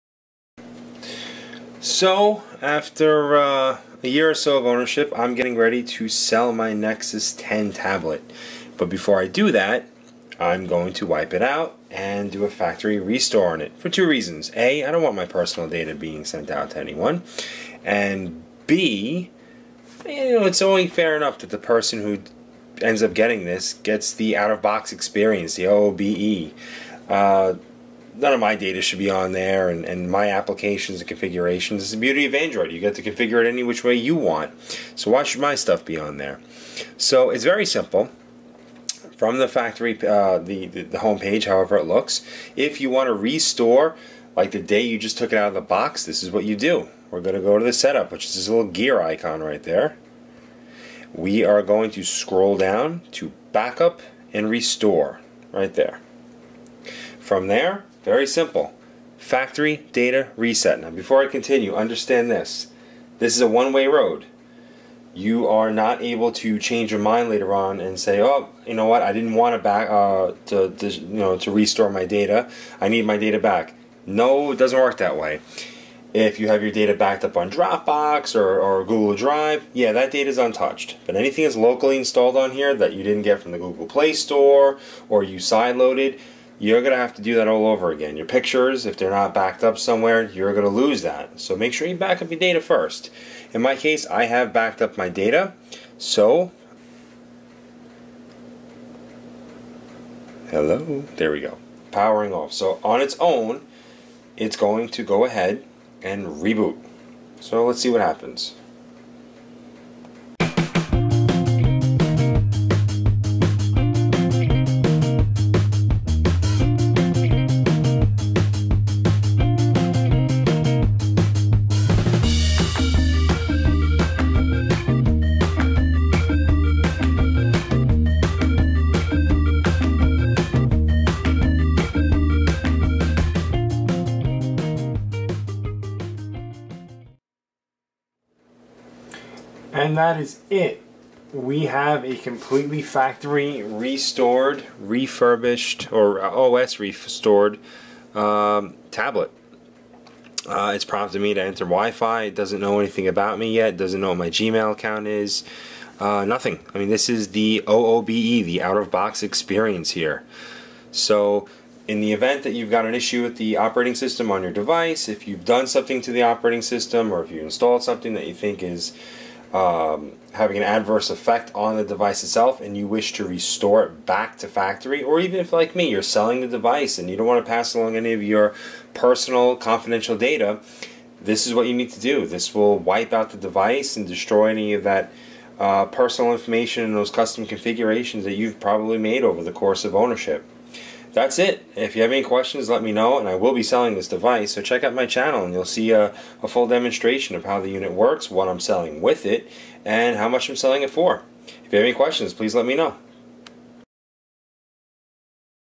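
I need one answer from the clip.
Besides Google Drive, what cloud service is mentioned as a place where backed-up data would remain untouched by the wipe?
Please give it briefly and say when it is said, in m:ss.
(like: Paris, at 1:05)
Dropbox, at 1:17.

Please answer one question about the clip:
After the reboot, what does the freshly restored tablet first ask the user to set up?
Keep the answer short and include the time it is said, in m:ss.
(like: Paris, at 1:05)
Wi-Fi, at 2:31.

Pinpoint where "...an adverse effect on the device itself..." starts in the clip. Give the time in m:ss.
2:50.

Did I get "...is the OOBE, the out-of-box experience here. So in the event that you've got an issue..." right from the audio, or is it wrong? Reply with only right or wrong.
right.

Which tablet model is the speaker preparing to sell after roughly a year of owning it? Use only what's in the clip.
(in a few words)
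Nexus 10.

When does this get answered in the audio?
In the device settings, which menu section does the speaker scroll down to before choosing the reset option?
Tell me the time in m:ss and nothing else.
0:53.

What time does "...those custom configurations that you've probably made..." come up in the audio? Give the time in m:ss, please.
3:06.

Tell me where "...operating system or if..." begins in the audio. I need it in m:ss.
2:46.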